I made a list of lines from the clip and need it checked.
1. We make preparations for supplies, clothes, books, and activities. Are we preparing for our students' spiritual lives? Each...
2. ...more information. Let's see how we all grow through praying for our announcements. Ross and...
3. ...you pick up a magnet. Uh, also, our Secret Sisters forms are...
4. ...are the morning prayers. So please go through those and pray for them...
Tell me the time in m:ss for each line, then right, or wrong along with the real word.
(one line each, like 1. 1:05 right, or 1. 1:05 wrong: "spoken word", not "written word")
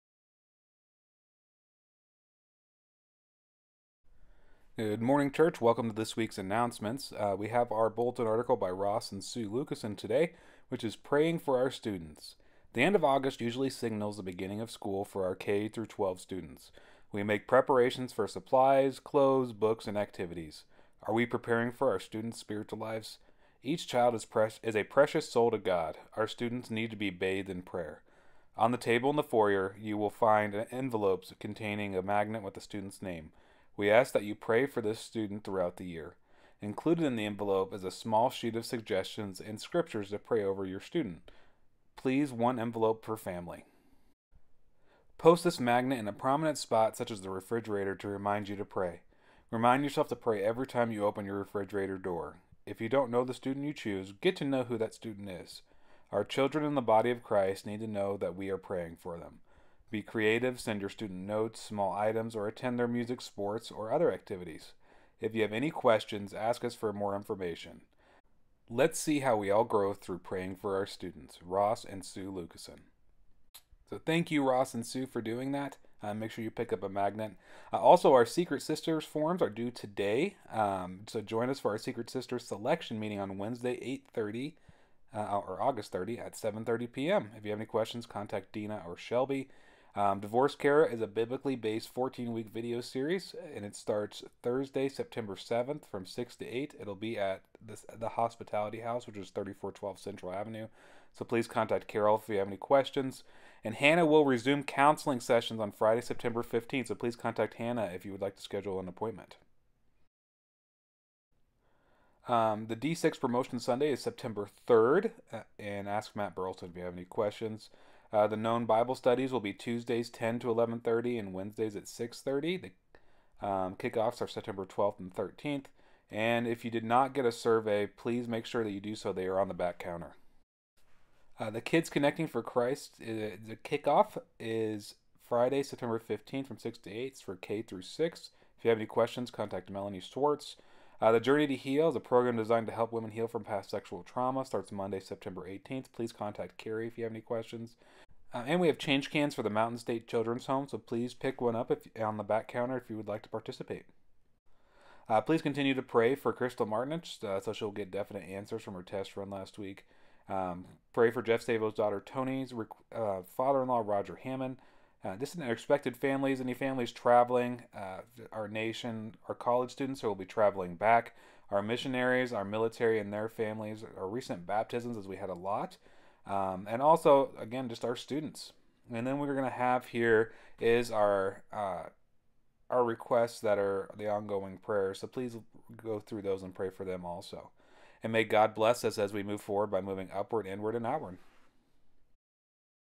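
1. 0:17 right
2. 1:06 wrong: "students", not "announcements"
3. 1:16 right
4. 3:03 wrong: "ongoing", not "morning".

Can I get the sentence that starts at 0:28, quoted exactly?
On the table in the foyer, you will find envelopes containing a magnet with the student's name.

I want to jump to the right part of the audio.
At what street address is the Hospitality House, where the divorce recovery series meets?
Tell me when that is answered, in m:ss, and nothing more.
1:39.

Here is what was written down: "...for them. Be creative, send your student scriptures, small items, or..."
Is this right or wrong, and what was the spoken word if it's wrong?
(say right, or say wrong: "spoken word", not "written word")
wrong: "notes", not "scriptures".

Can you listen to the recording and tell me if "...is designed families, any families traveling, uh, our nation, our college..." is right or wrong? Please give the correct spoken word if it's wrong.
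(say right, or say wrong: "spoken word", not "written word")
wrong: "expected", not "designed".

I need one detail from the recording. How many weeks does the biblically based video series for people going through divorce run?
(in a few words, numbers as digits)
14.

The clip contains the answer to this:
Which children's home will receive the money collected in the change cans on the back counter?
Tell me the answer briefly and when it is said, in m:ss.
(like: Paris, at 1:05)
Mountain State Children's Home, at 2:29.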